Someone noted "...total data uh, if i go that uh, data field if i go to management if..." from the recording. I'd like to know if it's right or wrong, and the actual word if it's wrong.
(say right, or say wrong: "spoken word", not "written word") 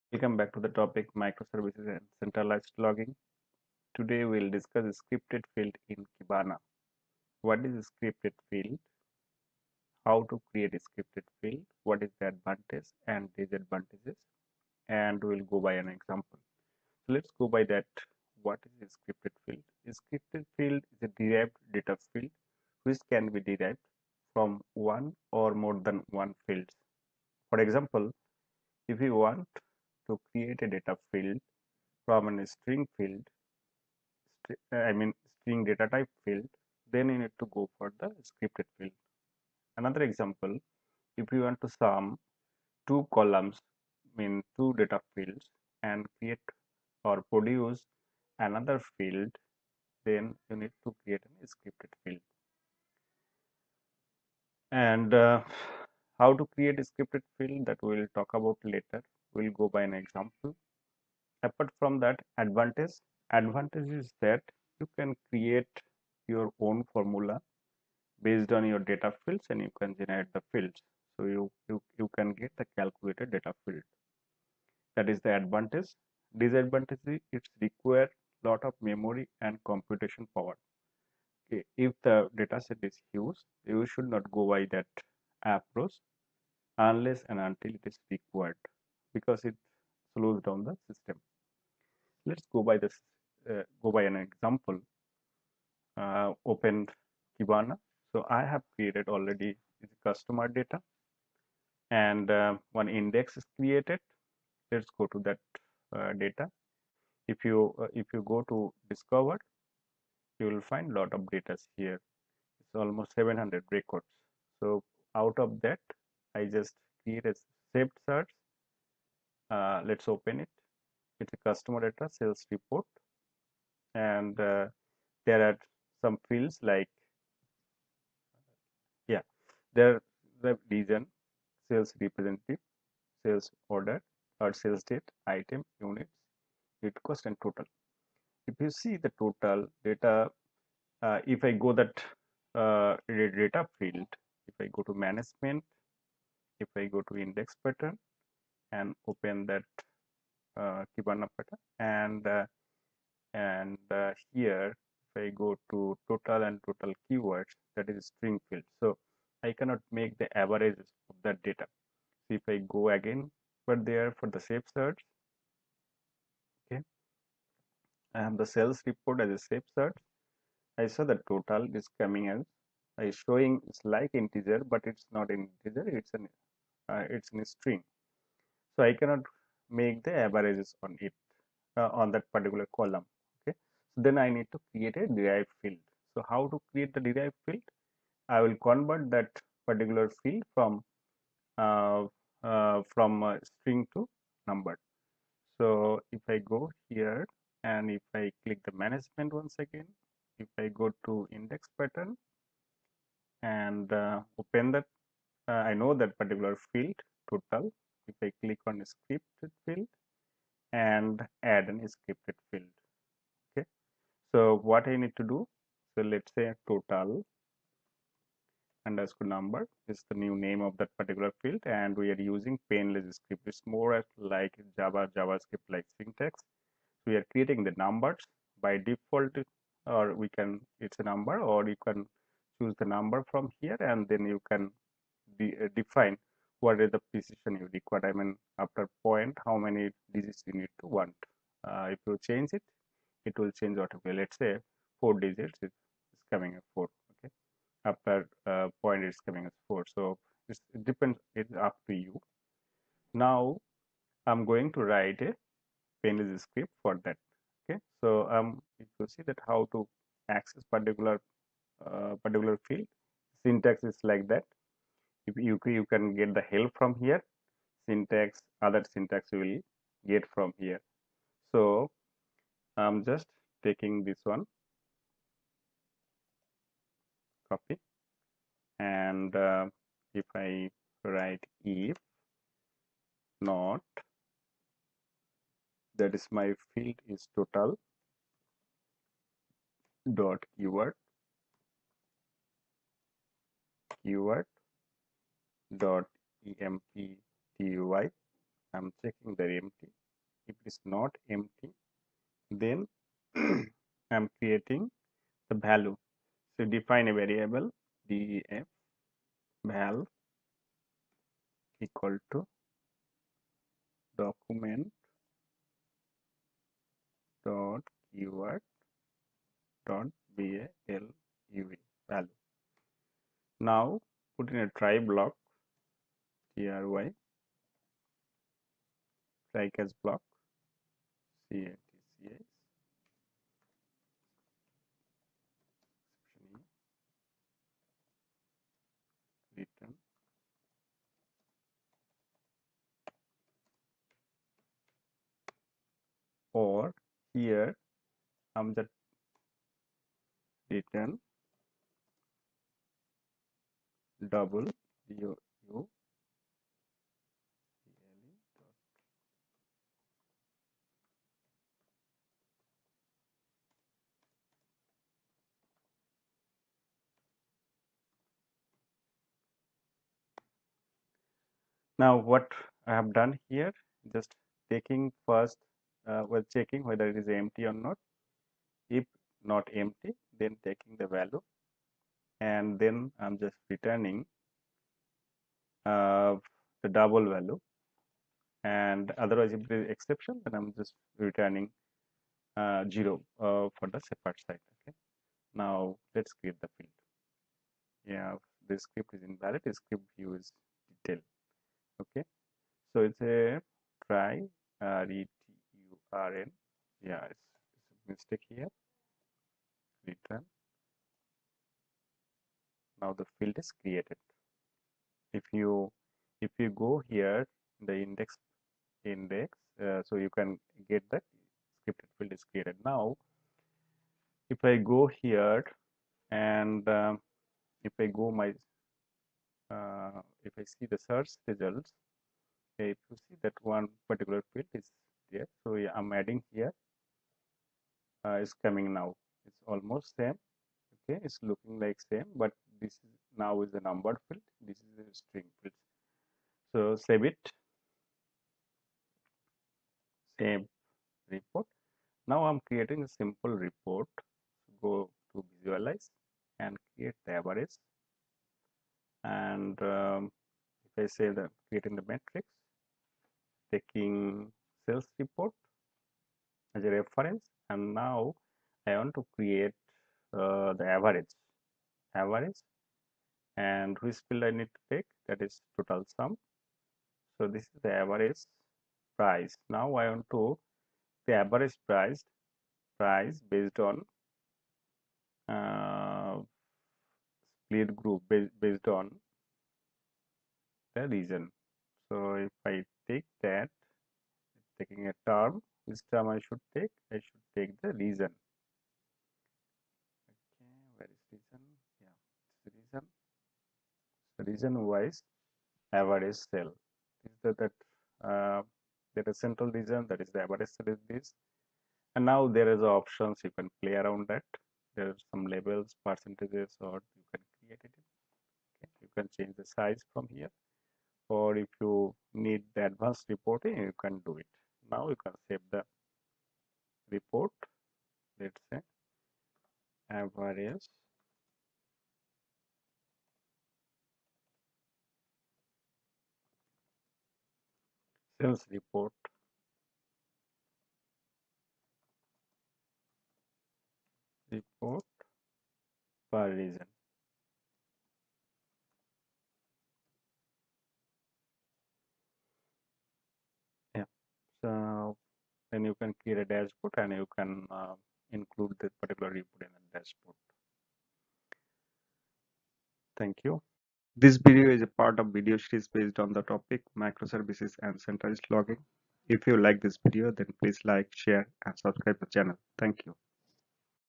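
right.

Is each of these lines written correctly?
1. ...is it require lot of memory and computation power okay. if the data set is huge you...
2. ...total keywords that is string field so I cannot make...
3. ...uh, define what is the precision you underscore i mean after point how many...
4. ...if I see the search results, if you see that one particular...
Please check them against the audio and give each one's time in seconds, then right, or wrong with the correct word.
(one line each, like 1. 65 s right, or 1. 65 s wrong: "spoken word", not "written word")
1. 77 s right
2. 156 s right
3. 235 s wrong: "require", not "underscore"
4. 430 s right.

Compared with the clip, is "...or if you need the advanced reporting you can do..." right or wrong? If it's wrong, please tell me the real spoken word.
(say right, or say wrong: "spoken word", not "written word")
right.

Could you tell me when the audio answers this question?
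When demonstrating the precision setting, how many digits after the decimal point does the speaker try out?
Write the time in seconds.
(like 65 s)
244 s.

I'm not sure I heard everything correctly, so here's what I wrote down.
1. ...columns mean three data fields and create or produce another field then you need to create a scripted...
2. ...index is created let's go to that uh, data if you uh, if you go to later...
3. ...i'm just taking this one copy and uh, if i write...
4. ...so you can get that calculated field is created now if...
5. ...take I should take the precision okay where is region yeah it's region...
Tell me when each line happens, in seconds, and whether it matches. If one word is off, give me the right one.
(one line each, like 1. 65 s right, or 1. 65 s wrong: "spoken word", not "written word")
1. 43 s wrong: "two", not "three"
2. 102 s wrong: "discover", not "later"
3. 272 s right
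4. 420 s wrong: "scripted", not "calculated"
5. 496 s wrong: "region", not "precision".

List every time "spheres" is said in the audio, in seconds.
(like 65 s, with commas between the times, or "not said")
not said.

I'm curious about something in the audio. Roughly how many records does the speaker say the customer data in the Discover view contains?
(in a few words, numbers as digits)
700.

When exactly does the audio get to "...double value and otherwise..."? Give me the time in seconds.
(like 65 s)
386 s.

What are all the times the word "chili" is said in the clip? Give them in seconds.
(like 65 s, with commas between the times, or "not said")
not said.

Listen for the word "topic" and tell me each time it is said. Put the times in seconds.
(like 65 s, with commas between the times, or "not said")
0 s, 566 s.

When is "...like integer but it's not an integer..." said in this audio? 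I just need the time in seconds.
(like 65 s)
173 s.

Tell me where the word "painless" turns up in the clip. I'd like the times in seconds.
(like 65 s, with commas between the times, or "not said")
222 s, 256 s.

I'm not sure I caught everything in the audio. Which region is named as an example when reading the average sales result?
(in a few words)
central.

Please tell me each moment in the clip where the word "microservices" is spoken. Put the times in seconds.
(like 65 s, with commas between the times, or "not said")
1 s, 566 s.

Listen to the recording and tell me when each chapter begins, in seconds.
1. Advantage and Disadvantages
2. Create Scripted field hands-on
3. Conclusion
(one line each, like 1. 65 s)
1. 65 s
2. 95 s
3. 568 s.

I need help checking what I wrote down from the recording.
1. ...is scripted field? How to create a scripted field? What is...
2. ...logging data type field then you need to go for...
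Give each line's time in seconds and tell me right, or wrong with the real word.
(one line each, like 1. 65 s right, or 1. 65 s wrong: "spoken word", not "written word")
1. 7 s right
2. 35 s wrong: "string", not "logging".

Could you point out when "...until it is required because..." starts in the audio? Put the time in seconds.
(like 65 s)
87 s.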